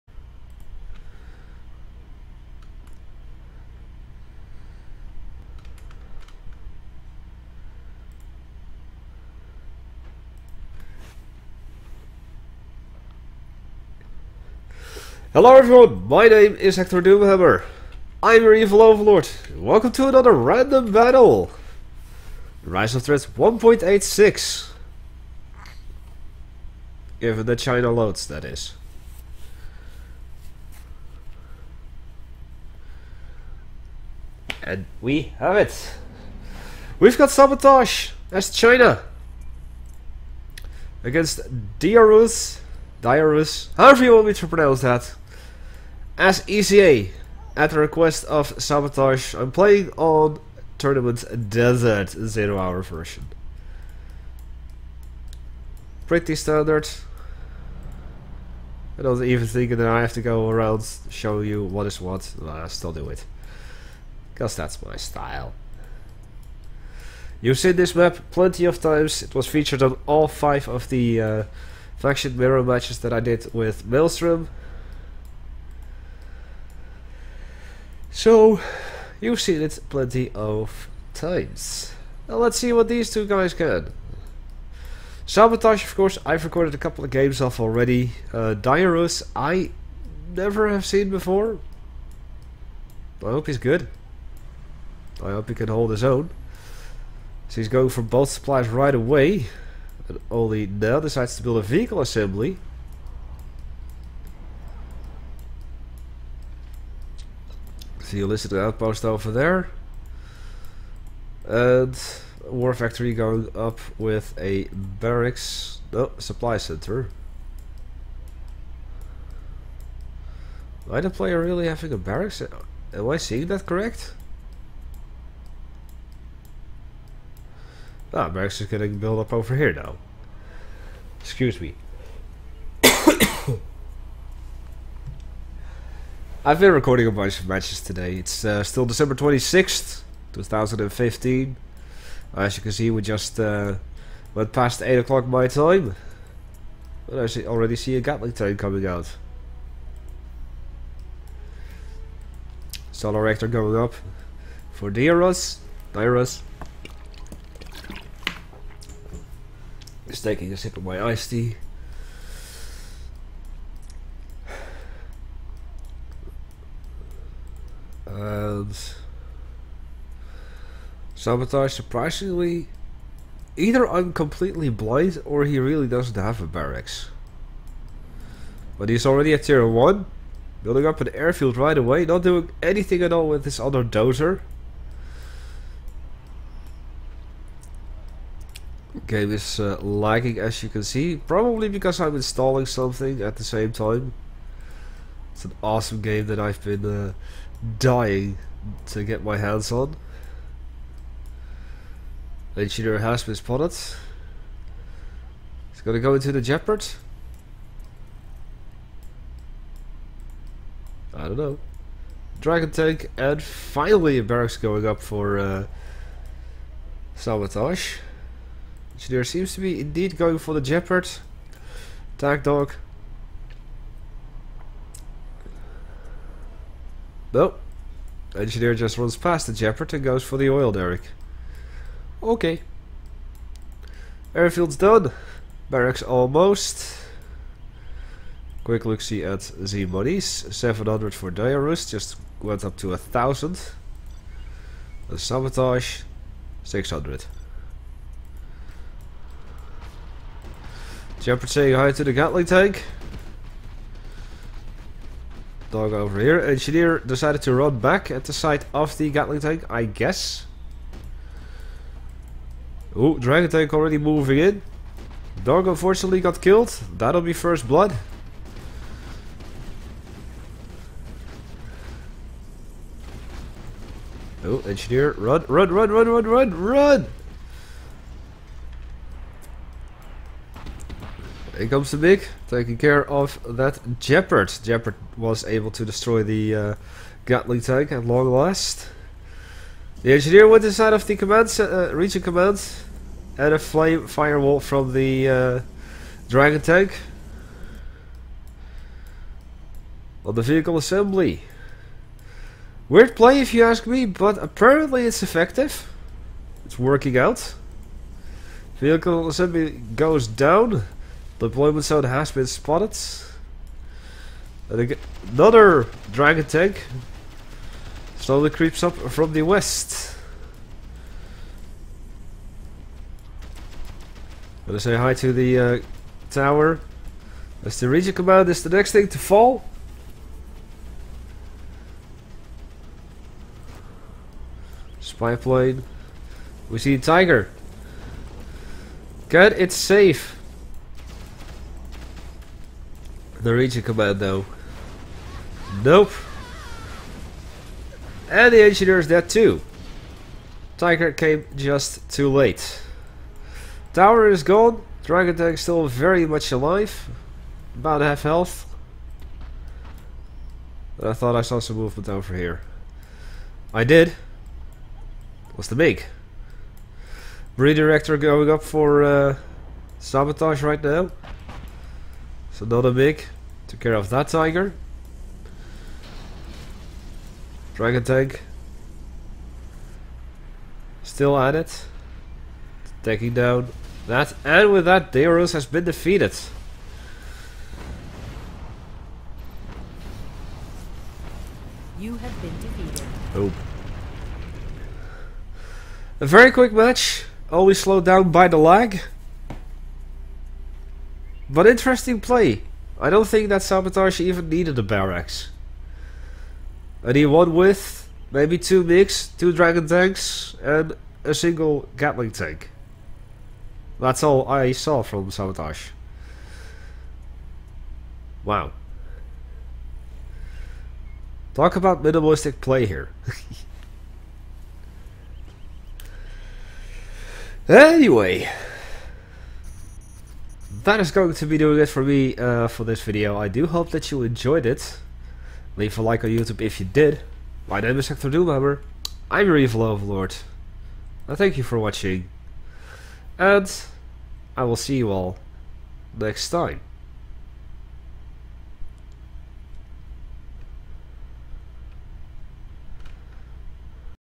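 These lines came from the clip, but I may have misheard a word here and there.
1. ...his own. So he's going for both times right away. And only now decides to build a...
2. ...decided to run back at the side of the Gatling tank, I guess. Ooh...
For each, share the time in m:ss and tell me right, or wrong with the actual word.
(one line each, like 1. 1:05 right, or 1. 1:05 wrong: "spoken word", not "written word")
1. 1:35 wrong: "supplies", not "times"
2. 4:16 right.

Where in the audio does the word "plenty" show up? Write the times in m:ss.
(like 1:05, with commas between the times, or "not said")
1:08, 1:19.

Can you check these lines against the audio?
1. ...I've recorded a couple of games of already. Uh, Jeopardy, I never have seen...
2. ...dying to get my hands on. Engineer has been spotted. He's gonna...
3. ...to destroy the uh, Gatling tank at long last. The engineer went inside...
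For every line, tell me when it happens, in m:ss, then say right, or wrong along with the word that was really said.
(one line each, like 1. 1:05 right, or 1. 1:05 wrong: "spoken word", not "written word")
1. 1:26 wrong: "Dioruz", not "Jeopardy"
2. 3:17 right
3. 4:45 right.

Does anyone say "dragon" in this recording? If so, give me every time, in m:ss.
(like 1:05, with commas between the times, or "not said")
3:32, 4:23, 4:56, 5:16, 5:55, 6:17, 6:49.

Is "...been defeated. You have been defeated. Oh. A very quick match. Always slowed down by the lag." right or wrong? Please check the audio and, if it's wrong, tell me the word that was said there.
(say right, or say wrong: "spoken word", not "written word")
right.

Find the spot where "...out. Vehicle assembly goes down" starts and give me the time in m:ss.
5:07.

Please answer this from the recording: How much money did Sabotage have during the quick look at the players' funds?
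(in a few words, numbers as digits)
600.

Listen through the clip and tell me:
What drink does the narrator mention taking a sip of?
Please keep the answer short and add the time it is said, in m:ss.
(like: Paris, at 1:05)
Iced tea, at 2:41.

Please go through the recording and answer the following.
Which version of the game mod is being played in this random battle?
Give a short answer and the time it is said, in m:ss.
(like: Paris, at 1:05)
1.86, at 0:23.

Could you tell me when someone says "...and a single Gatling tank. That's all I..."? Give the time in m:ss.
6:50.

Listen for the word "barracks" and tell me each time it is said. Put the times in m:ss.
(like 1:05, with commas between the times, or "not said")
1:54, 2:01, 2:08, 2:56, 3:34, 3:55, 6:44.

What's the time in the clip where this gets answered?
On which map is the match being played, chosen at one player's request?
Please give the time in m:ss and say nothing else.
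0:50.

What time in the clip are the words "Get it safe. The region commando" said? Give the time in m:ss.
5:39.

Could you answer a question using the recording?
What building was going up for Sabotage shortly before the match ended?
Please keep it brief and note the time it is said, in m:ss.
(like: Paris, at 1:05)
Redirector, at 6:07.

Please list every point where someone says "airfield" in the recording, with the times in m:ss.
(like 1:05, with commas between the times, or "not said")
3:01, 3:54.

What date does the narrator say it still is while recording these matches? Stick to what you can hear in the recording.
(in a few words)
December 26th, 2015.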